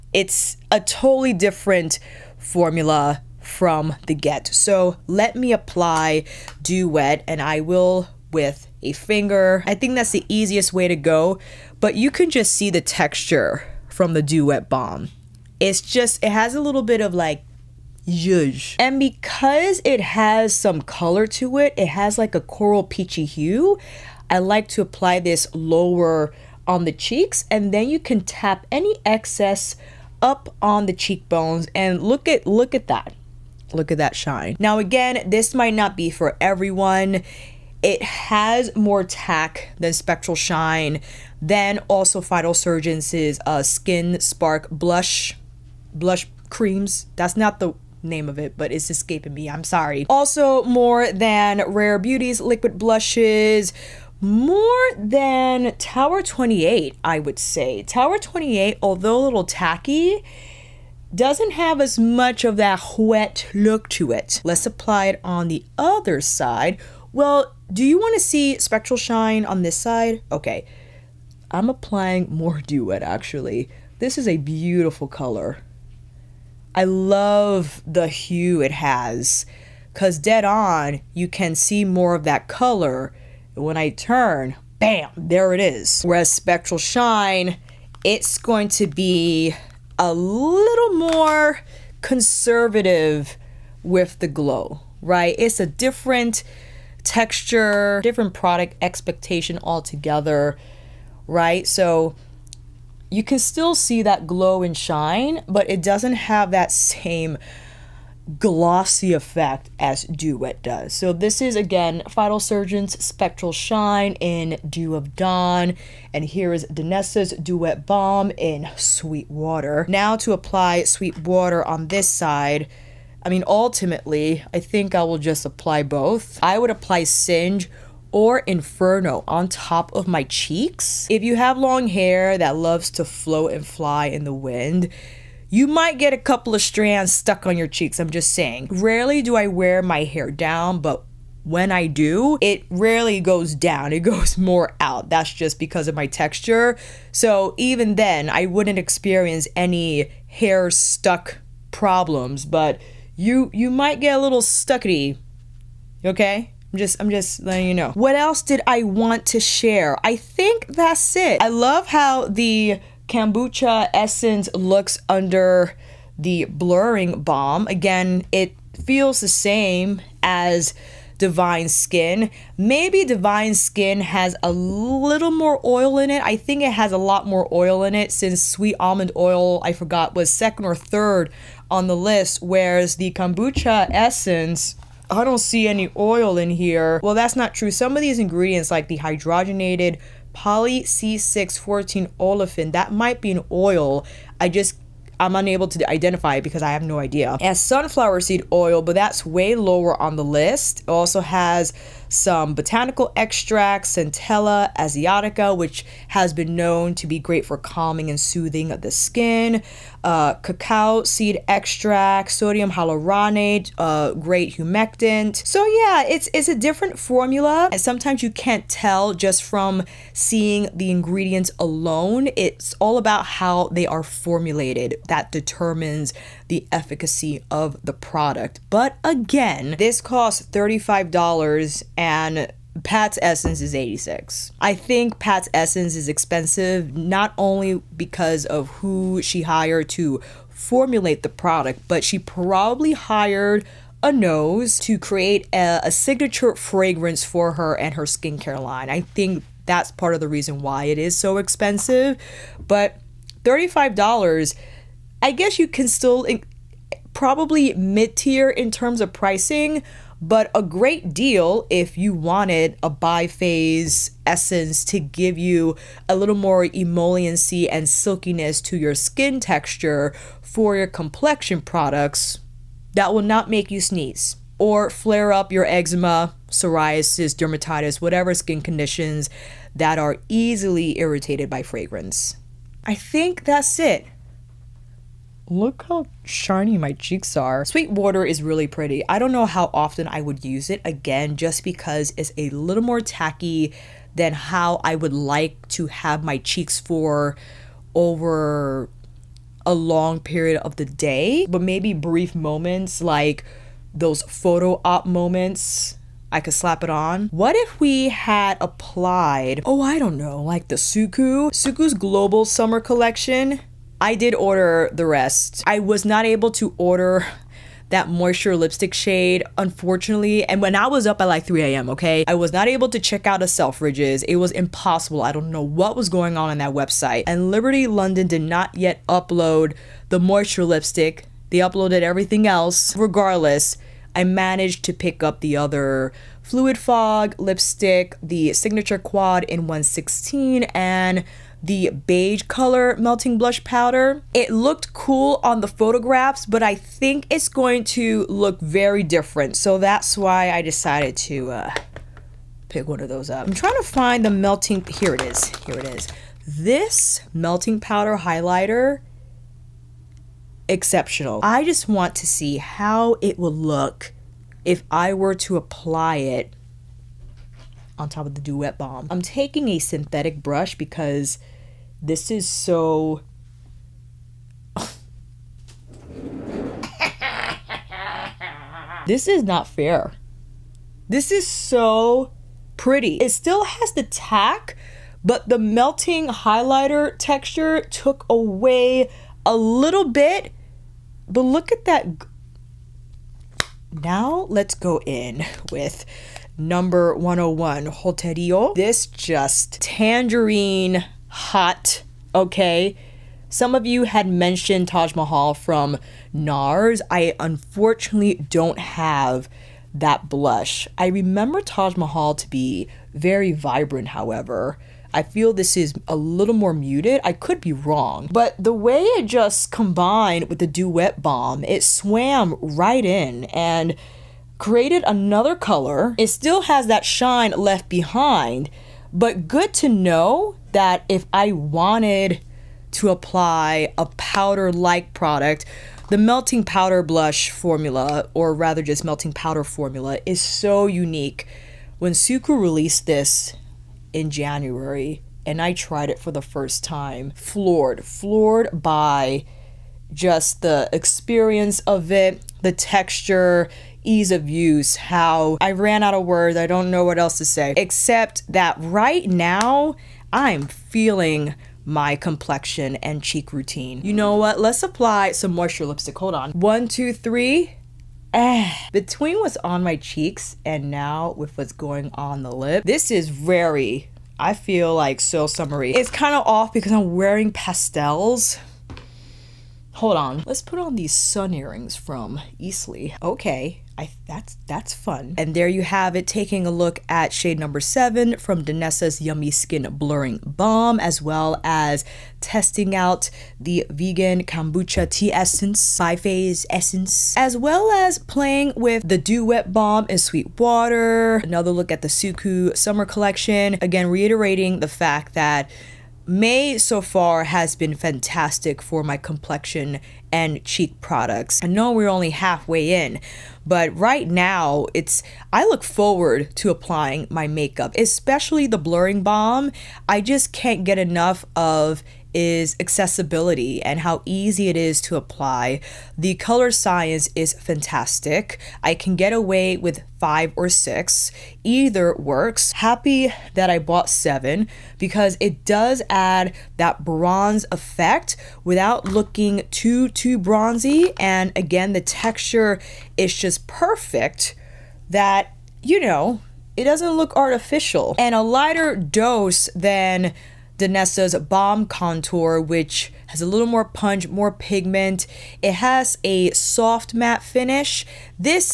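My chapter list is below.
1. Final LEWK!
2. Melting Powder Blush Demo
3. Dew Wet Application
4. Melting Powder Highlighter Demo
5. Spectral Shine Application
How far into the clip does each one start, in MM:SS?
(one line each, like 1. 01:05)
1. 08:03
2. 06:33
3. 00:17
4. 05:55
5. 01:24.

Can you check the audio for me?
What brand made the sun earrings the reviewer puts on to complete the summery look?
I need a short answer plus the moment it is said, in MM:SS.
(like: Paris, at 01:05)
Eastley, at 08:02.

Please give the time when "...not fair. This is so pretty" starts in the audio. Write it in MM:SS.
06:19.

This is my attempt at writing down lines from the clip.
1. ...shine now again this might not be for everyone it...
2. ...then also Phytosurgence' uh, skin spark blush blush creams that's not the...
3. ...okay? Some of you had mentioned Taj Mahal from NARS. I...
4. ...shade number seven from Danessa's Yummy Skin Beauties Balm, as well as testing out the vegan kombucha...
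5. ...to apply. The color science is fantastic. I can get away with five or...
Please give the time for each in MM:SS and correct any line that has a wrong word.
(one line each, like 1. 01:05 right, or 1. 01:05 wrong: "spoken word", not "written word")
1. 00:34 right
2. 00:41 right
3. 06:42 right
4. 08:07 wrong: "Blurring", not "Beauties"
5. 08:45 right.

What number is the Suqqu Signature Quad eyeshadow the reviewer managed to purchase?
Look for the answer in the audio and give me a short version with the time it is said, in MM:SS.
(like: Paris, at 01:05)
116, at 05:39.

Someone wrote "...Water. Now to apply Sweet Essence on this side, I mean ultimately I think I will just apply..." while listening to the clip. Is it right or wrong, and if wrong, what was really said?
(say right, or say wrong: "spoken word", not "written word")
wrong: "Water", not "Essence".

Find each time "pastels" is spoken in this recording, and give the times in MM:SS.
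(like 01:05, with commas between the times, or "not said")
07:57.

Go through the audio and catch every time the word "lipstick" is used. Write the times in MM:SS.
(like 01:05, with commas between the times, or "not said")
05:18, 05:30, 05:37, 07:45.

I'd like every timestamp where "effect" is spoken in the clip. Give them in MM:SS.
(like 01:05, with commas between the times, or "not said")
01:49, 08:57.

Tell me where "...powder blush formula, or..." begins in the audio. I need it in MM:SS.
07:16.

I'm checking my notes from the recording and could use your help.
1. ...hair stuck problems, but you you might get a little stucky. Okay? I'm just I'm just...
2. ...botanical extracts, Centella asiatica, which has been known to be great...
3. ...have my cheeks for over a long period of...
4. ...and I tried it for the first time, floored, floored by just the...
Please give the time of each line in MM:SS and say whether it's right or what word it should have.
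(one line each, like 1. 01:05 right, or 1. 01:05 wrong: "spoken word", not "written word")
1. 02:30 right
2. 03:22 right
3. 04:55 right
4. 07:25 right.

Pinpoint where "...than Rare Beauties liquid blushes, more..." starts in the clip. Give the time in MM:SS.
00:51.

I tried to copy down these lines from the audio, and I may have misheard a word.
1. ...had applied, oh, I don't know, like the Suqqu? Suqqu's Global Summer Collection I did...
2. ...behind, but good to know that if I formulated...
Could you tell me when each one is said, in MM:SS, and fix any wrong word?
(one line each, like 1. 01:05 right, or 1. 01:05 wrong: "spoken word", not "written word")
1. 05:08 right
2. 07:07 wrong: "wanted", not "formulated".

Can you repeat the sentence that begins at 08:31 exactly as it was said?
I know we're only halfway in, but right now it's I look forward to applying my makeup, especially the blurring balm.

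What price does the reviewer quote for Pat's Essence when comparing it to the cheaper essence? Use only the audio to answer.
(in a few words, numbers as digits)
$86.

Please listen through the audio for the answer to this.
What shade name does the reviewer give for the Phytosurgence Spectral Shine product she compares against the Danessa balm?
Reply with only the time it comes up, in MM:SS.
01:54.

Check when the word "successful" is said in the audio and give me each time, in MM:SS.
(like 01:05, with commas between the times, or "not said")
not said.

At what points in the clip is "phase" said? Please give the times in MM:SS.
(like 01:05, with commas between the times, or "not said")
04:23, 08:15.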